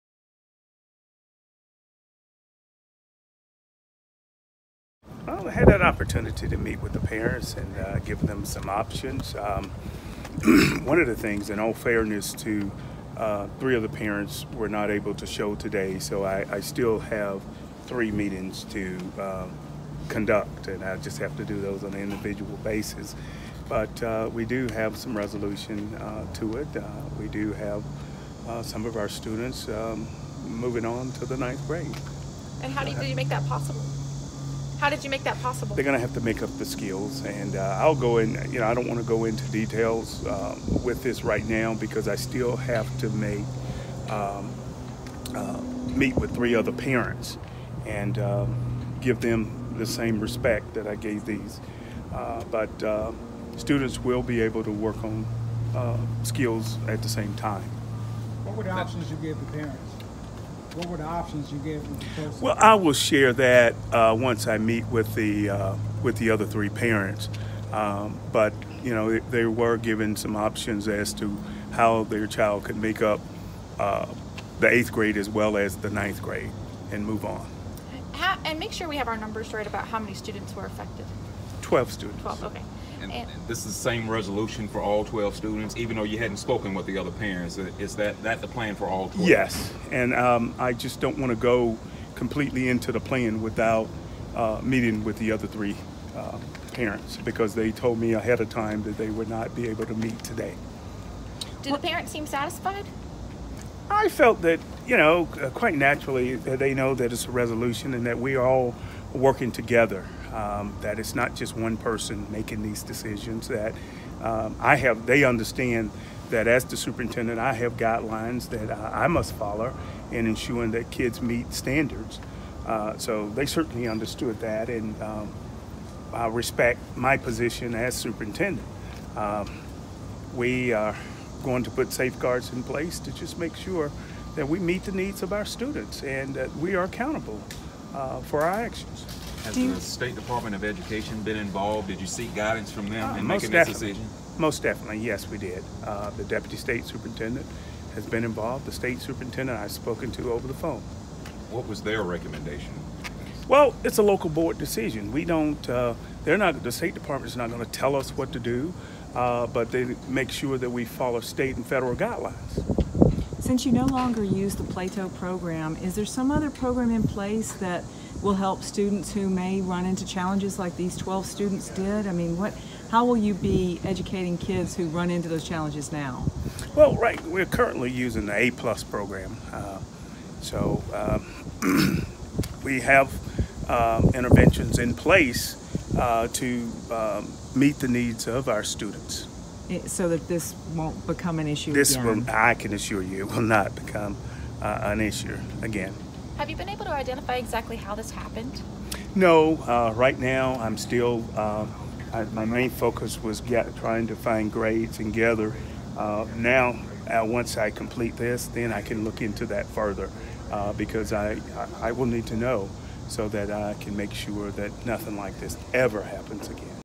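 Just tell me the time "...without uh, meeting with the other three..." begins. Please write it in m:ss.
1:33.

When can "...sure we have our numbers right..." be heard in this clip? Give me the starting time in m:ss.
1:18.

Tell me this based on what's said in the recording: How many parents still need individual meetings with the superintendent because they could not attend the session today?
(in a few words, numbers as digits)
3.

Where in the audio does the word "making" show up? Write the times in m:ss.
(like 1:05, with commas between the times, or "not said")
1:52, 2:23.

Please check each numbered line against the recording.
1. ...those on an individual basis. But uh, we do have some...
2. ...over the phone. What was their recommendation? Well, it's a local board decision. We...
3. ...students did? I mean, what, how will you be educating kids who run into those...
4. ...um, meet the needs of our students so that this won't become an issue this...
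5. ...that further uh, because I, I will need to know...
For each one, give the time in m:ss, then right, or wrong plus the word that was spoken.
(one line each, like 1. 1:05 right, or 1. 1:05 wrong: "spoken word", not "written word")
1. 0:21 right
2. 2:30 right
3. 2:51 right
4. 3:06 right
5. 3:29 right.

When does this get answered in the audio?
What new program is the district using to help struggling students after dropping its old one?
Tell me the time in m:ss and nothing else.
2:58.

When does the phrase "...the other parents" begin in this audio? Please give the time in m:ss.
1:26.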